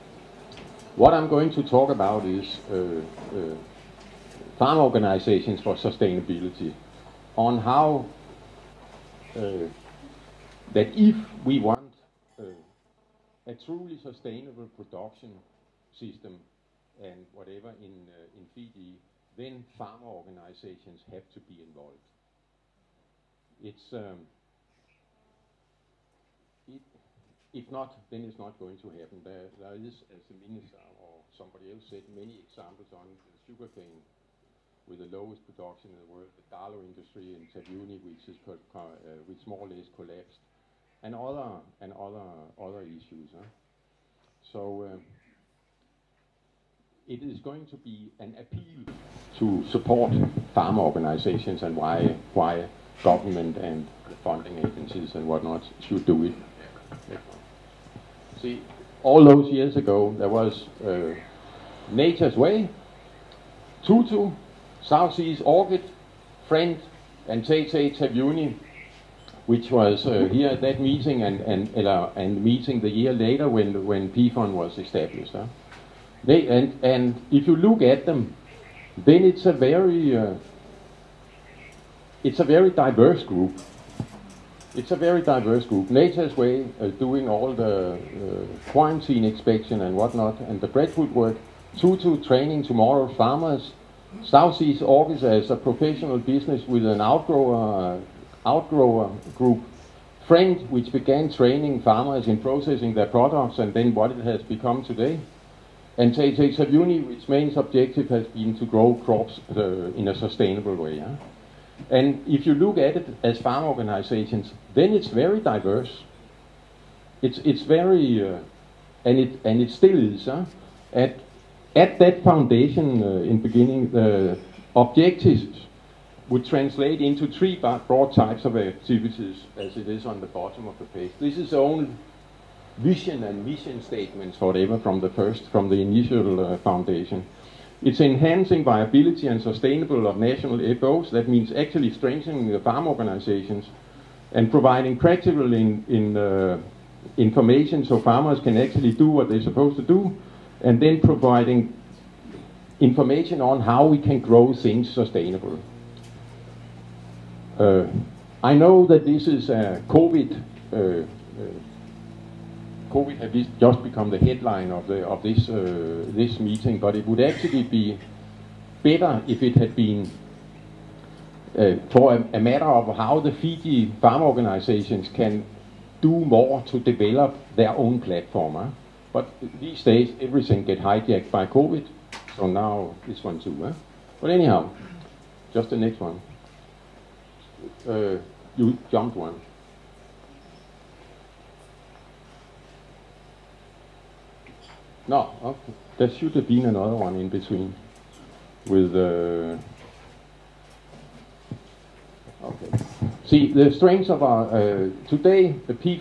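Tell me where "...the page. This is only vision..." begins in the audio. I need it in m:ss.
2:10.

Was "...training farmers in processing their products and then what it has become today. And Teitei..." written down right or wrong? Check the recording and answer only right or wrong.
right.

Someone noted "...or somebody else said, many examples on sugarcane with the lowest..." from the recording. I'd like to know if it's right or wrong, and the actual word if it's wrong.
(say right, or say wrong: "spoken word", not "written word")
right.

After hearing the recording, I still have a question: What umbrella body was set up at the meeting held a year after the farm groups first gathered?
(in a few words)
PFON.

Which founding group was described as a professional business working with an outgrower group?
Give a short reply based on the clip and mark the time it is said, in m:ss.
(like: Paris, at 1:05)
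South Seas Orchids, at 1:34.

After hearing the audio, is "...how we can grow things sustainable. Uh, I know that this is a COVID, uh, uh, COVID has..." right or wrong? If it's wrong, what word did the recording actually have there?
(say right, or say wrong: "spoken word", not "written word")
right.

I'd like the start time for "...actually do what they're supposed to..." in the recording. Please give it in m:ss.
2:28.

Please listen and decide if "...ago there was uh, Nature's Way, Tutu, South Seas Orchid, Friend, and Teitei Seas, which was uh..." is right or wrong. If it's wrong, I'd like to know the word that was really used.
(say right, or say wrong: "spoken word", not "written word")
wrong: "Taveuni", not "Seas".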